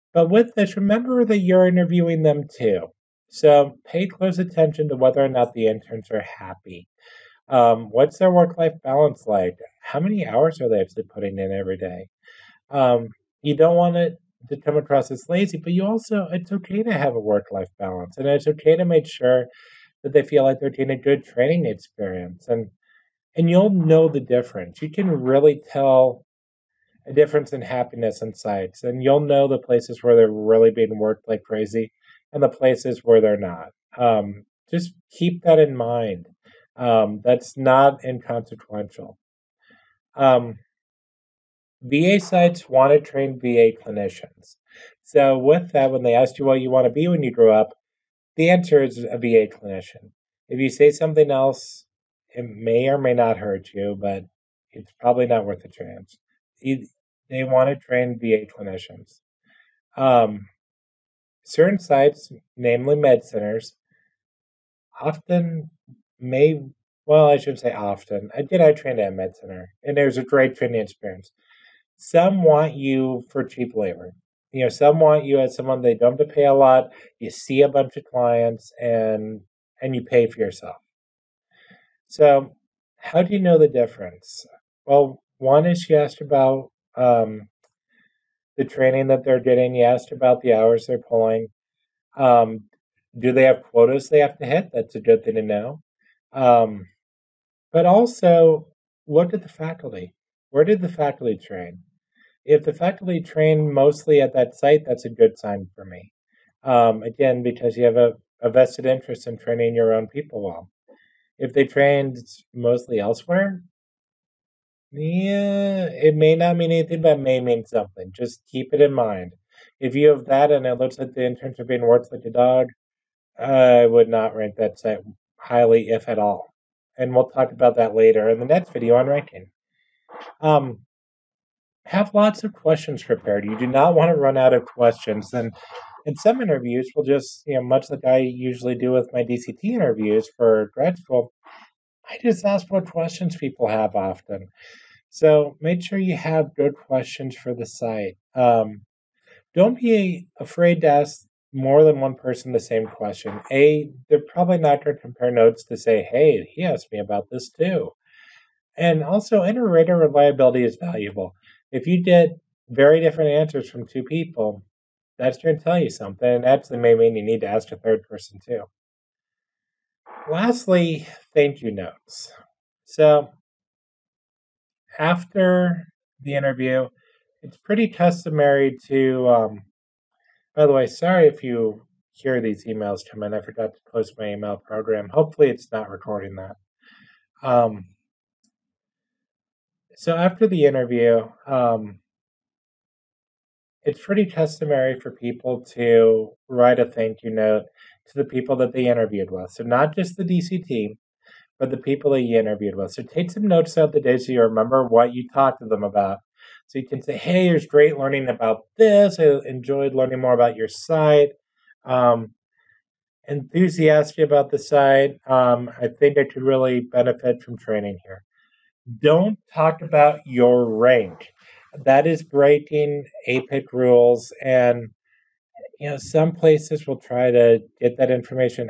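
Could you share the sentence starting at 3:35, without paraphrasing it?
Um, I think I could really benefit from training here.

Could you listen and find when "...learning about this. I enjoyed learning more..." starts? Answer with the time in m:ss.
3:27.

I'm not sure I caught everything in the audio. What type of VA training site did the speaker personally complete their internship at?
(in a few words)
med center.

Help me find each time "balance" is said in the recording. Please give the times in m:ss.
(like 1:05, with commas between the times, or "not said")
0:08, 0:17.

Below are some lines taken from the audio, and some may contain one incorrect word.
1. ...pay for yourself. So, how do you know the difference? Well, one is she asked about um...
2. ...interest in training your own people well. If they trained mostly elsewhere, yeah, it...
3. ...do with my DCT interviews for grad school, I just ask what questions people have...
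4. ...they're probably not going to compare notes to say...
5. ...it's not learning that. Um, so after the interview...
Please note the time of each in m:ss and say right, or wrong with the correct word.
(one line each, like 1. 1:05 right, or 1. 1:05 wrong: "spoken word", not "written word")
1. 1:20 right
2. 1:48 right
3. 2:18 right
4. 2:34 right
5. 3:05 wrong: "recording", not "learning".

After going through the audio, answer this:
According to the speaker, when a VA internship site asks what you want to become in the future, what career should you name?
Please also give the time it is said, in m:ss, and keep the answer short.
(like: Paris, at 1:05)
VA clinician, at 0:49.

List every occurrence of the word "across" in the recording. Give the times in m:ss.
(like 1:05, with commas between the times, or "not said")
0:14.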